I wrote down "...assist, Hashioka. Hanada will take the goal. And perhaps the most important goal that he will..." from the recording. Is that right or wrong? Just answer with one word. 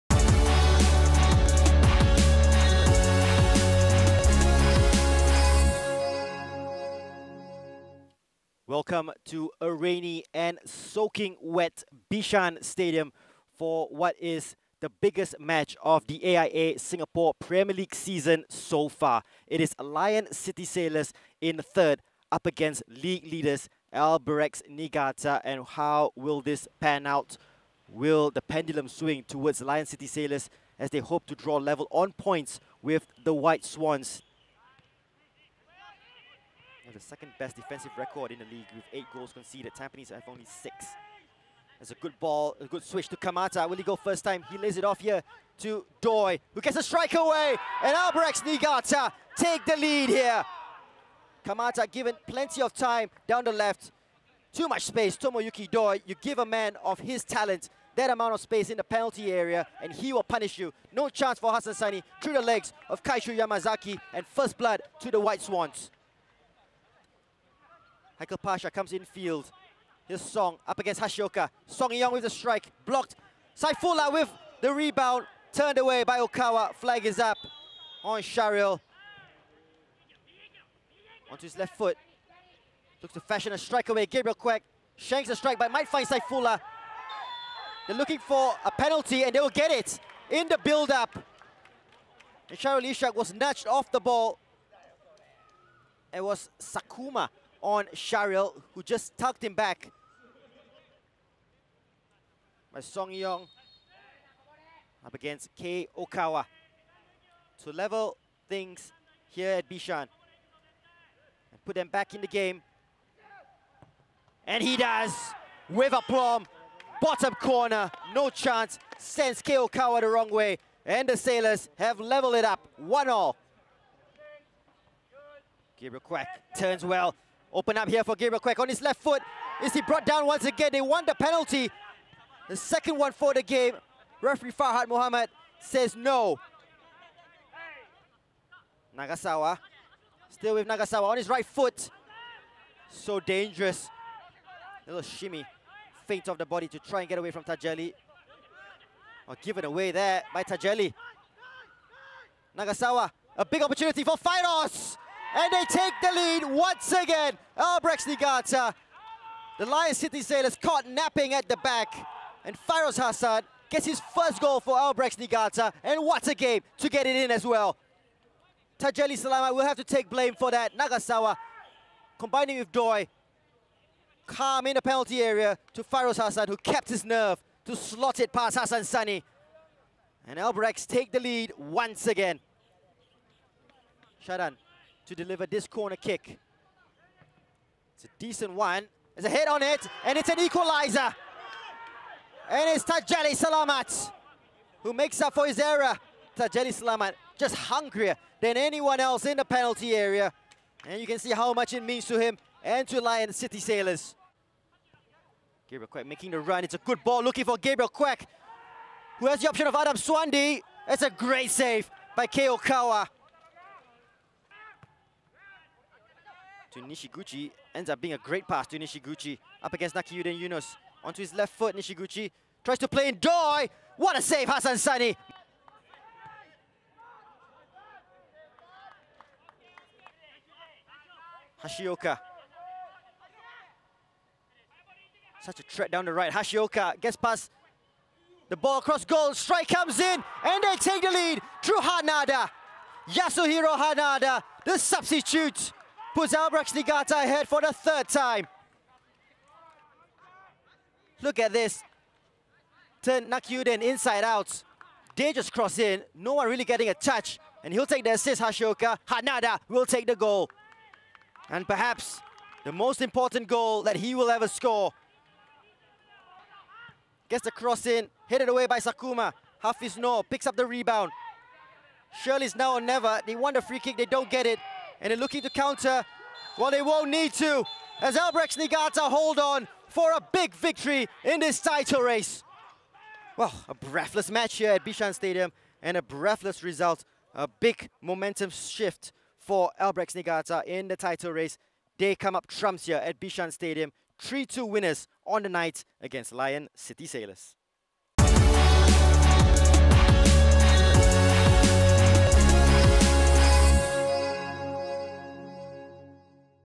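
right.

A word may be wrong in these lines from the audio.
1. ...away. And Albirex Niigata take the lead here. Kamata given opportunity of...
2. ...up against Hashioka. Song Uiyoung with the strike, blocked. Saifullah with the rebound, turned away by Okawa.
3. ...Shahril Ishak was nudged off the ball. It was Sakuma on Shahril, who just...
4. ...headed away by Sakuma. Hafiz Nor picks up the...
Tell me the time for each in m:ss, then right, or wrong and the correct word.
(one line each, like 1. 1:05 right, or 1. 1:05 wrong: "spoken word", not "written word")
1. 0:47 wrong: "plenty", not "opportunity"
2. 1:10 right
3. 1:32 right
4. 4:28 right.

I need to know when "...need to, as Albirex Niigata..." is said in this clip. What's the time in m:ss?
4:37.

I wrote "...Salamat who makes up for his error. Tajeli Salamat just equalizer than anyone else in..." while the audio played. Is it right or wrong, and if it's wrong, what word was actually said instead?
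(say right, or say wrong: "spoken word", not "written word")
wrong: "hungrier", not "equalizer".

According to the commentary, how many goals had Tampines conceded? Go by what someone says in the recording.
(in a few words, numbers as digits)
6.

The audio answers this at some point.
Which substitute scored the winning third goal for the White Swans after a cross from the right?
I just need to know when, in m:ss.
4:03.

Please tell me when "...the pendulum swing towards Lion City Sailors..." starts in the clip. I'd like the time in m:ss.
0:28.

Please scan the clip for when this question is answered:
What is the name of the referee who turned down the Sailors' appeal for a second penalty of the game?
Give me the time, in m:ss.
2:14.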